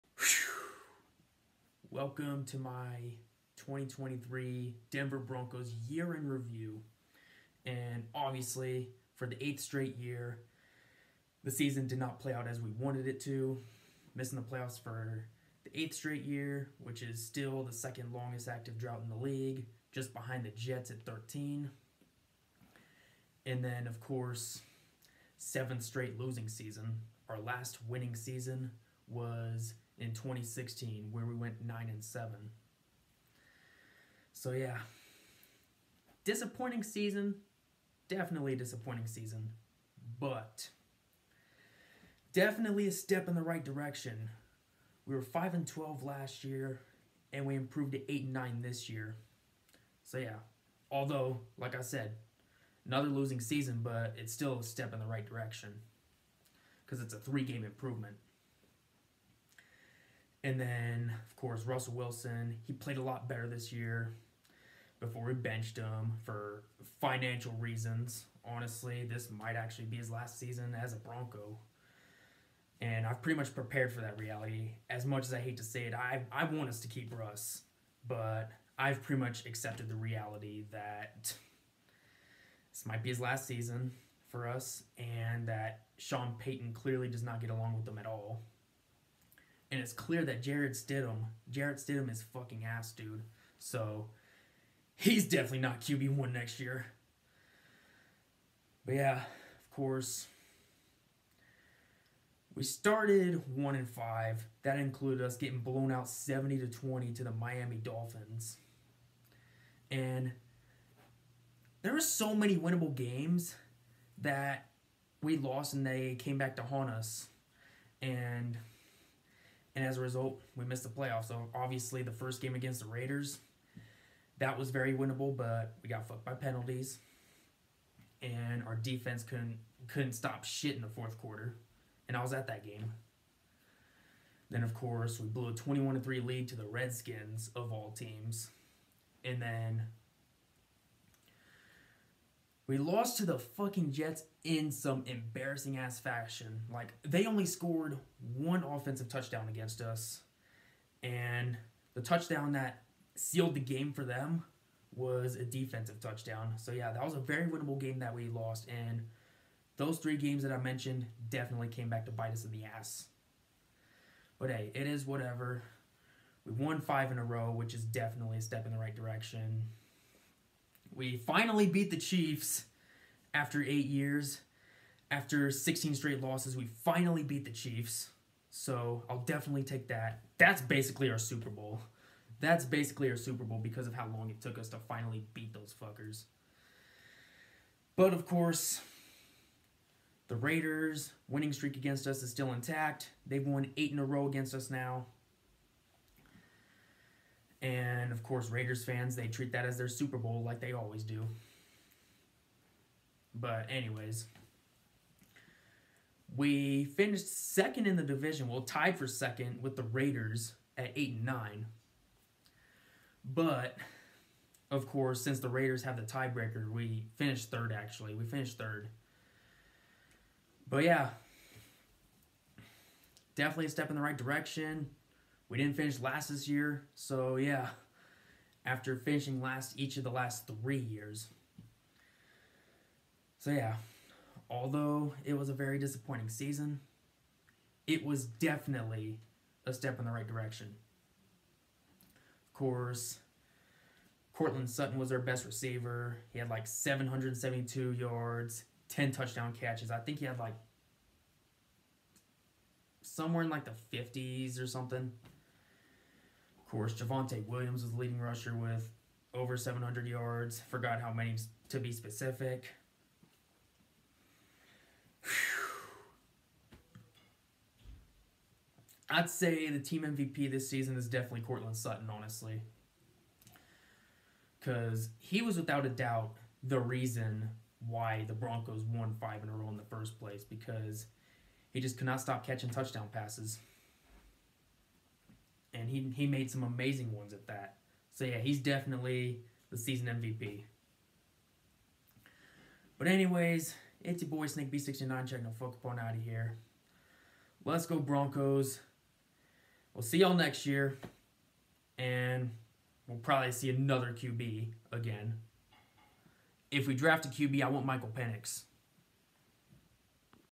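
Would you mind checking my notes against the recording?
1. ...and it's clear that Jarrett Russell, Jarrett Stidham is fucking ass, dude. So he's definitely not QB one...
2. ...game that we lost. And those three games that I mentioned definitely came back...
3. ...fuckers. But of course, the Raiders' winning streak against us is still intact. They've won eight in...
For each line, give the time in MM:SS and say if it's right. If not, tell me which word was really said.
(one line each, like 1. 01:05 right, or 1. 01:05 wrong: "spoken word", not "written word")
1. 01:29 wrong: "Stidham", not "Russell"
2. 02:37 right
3. 03:05 right.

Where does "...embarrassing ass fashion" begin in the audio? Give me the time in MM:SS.
02:25.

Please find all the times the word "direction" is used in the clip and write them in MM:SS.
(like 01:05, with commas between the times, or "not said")
00:43, 00:55, 02:48, 03:44, 04:00.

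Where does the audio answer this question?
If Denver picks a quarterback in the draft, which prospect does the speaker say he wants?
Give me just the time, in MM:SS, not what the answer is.
05:07.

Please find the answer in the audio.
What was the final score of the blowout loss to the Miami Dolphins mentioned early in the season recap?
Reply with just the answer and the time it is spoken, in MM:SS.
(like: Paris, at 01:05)
70 to 20, at 01:46.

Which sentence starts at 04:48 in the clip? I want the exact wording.
So yeah, he's definitely the season MVP.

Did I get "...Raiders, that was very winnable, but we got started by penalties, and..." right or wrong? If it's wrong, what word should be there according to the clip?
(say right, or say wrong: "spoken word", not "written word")
wrong: "fucked", not "started".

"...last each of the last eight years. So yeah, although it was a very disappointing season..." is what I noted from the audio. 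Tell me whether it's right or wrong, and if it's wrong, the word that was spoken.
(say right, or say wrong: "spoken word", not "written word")
wrong: "three", not "eight".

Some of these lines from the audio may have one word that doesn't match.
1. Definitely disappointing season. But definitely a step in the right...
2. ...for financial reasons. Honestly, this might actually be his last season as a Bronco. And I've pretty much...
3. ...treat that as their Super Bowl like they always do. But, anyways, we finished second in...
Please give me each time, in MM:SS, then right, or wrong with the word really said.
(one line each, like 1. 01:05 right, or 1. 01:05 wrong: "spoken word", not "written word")
1. 00:38 right
2. 01:06 right
3. 03:19 right.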